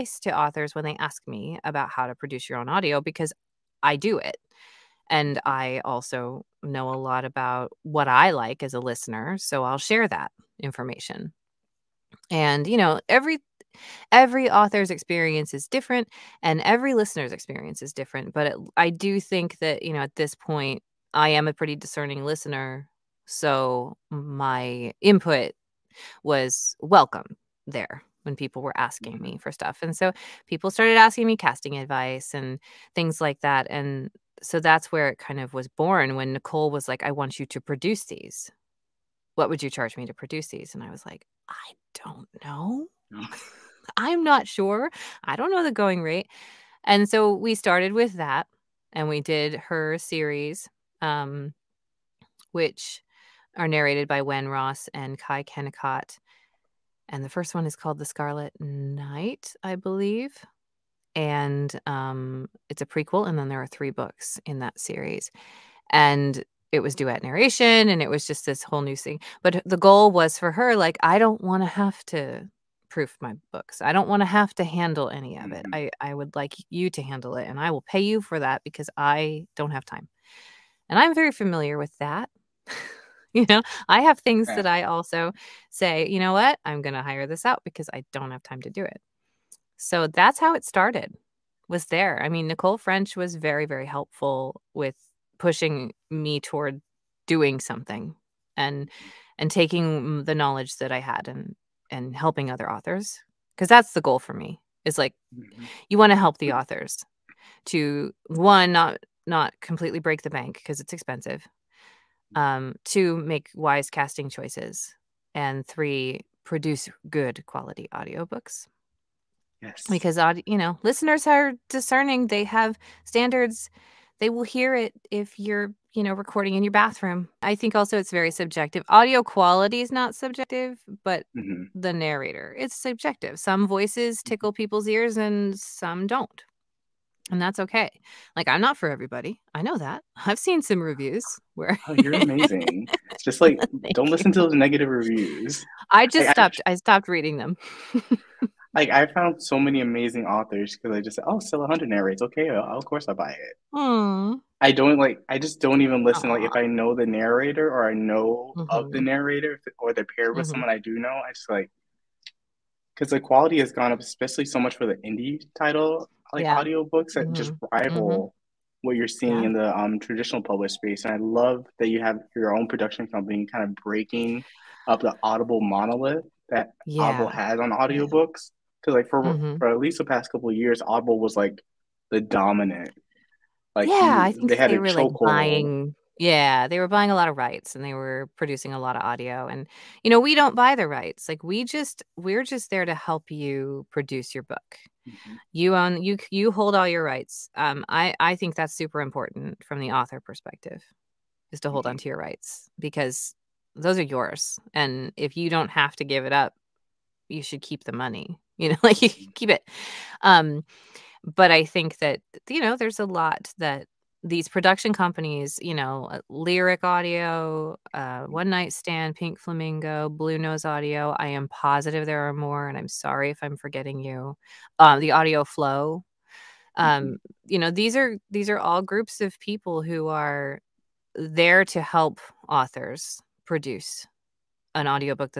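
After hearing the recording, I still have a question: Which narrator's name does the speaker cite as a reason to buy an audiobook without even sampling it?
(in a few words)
Stella Hunter.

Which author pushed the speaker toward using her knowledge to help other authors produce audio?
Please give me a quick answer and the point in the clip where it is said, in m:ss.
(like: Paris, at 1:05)
Nicole French, at 1:32.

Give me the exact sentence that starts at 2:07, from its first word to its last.
I think also it's very subjective.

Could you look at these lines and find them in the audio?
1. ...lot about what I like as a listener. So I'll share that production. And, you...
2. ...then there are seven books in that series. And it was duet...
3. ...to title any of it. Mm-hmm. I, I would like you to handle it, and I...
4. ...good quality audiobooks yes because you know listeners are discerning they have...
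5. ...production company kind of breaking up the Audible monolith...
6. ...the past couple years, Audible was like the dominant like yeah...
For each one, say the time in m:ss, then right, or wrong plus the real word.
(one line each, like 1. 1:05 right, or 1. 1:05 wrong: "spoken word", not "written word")
1. 0:06 wrong: "information", not "production"
2. 1:03 wrong: "three", not "seven"
3. 1:14 wrong: "handle", not "title"
4. 1:57 right
5. 2:52 right
6. 2:59 right.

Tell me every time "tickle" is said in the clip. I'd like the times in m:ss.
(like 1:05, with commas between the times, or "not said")
2:14.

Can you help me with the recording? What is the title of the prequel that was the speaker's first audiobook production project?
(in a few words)
The Scarlet Night.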